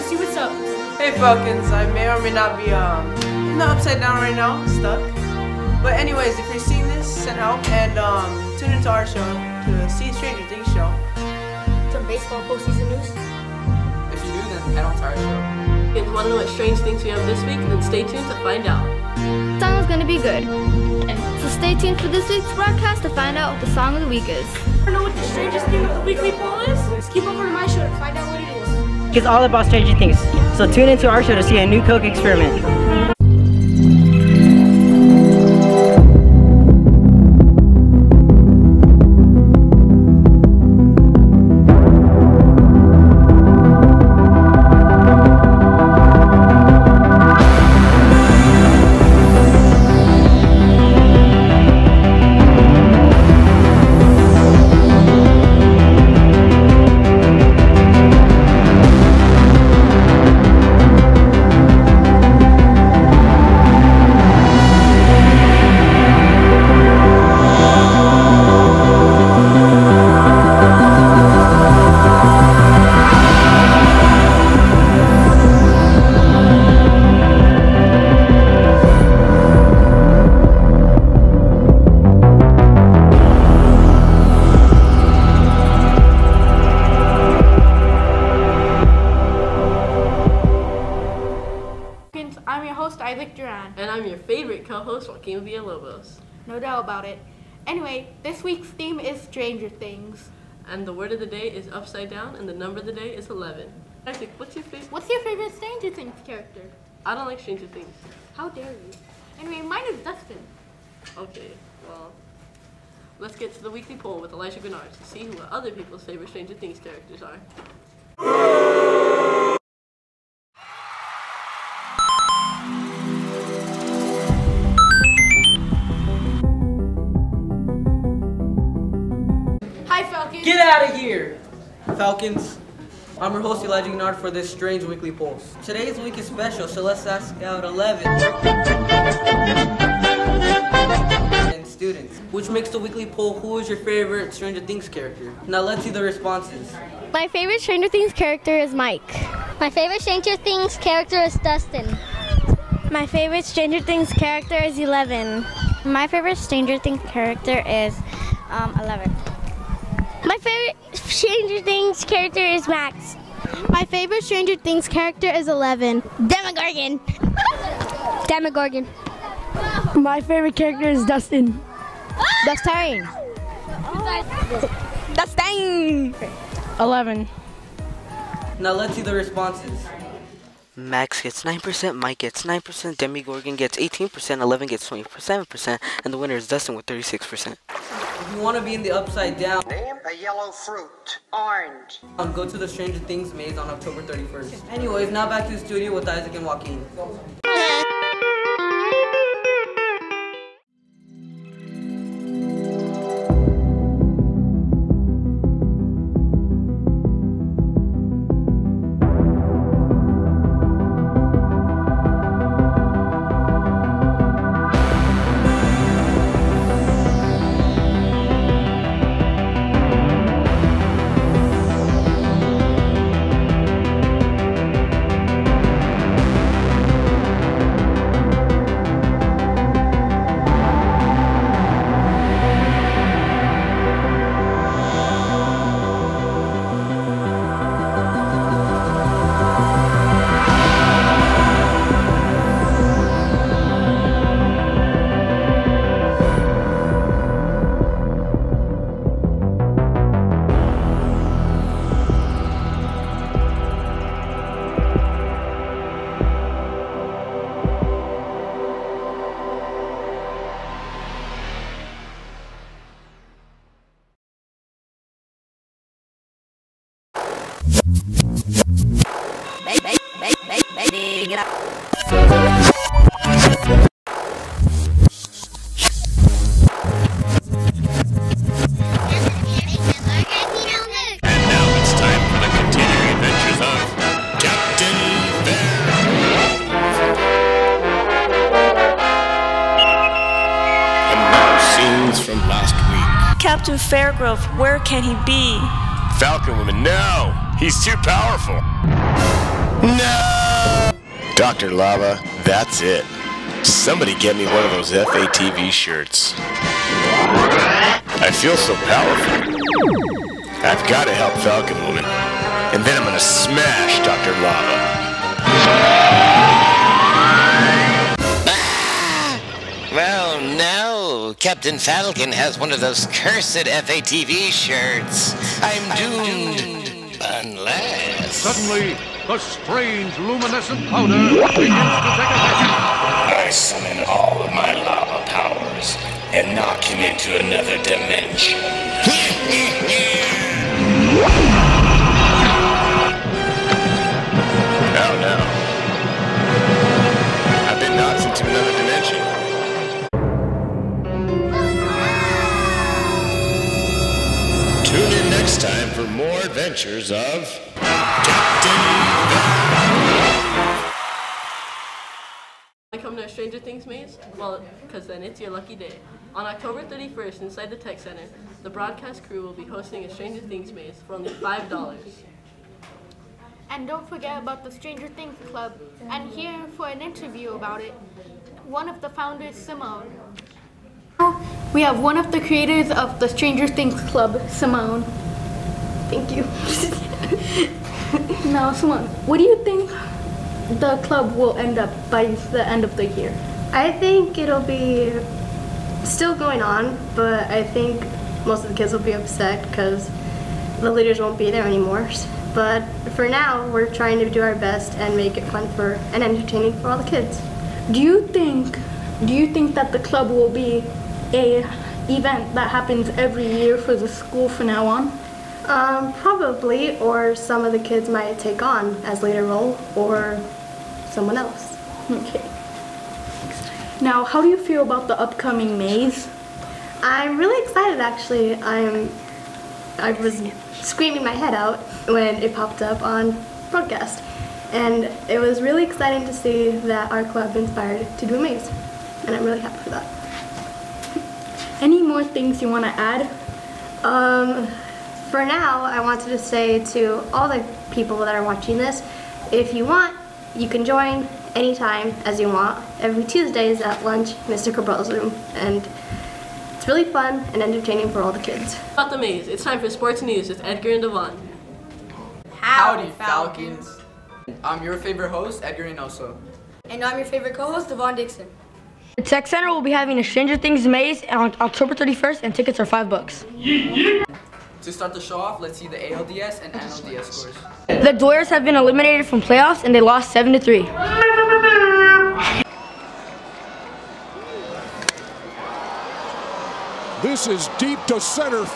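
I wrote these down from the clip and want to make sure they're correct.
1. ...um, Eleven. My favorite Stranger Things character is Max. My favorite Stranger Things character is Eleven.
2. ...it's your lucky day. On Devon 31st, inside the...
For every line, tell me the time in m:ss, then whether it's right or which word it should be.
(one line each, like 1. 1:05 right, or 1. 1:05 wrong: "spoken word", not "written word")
1. 2:38 right
2. 6:05 wrong: "October", not "Devon".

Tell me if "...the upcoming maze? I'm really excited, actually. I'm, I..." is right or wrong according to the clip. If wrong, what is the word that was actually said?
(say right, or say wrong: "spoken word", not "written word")
right.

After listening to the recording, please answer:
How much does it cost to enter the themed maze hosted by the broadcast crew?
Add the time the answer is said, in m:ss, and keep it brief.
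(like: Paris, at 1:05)
$5, at 6:11.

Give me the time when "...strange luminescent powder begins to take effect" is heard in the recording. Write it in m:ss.
5:29.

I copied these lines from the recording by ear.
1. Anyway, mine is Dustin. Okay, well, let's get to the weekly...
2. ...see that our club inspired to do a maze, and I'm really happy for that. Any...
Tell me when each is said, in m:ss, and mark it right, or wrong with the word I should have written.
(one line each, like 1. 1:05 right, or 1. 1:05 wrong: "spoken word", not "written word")
1. 1:49 right
2. 7:16 right.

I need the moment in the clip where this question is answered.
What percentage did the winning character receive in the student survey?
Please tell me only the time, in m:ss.
3:06.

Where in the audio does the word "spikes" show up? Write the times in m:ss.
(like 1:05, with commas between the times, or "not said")
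not said.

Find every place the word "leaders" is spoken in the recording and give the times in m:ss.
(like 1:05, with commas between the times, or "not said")
6:40, 6:59.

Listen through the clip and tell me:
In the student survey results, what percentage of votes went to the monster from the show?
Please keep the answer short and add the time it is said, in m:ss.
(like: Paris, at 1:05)
18%, at 3:02.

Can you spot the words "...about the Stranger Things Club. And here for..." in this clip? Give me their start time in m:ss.
6:14.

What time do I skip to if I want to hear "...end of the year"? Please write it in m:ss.
6:32.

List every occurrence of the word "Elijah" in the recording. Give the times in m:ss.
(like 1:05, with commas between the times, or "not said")
1:54, 2:13.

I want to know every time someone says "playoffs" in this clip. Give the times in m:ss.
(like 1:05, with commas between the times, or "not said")
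7:59.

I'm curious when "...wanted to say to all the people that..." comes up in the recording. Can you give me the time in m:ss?
7:26.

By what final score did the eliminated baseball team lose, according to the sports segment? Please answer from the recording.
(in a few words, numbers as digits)
7-3.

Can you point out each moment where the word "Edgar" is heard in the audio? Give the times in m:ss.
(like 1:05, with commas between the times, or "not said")
7:40, 7:45.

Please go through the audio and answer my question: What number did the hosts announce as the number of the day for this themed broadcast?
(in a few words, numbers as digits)
11.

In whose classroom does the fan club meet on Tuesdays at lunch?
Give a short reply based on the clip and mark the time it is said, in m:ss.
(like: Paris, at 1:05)
Mr. Cabral's, at 7:34.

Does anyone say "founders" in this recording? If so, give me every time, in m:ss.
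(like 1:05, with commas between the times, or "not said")
6:19.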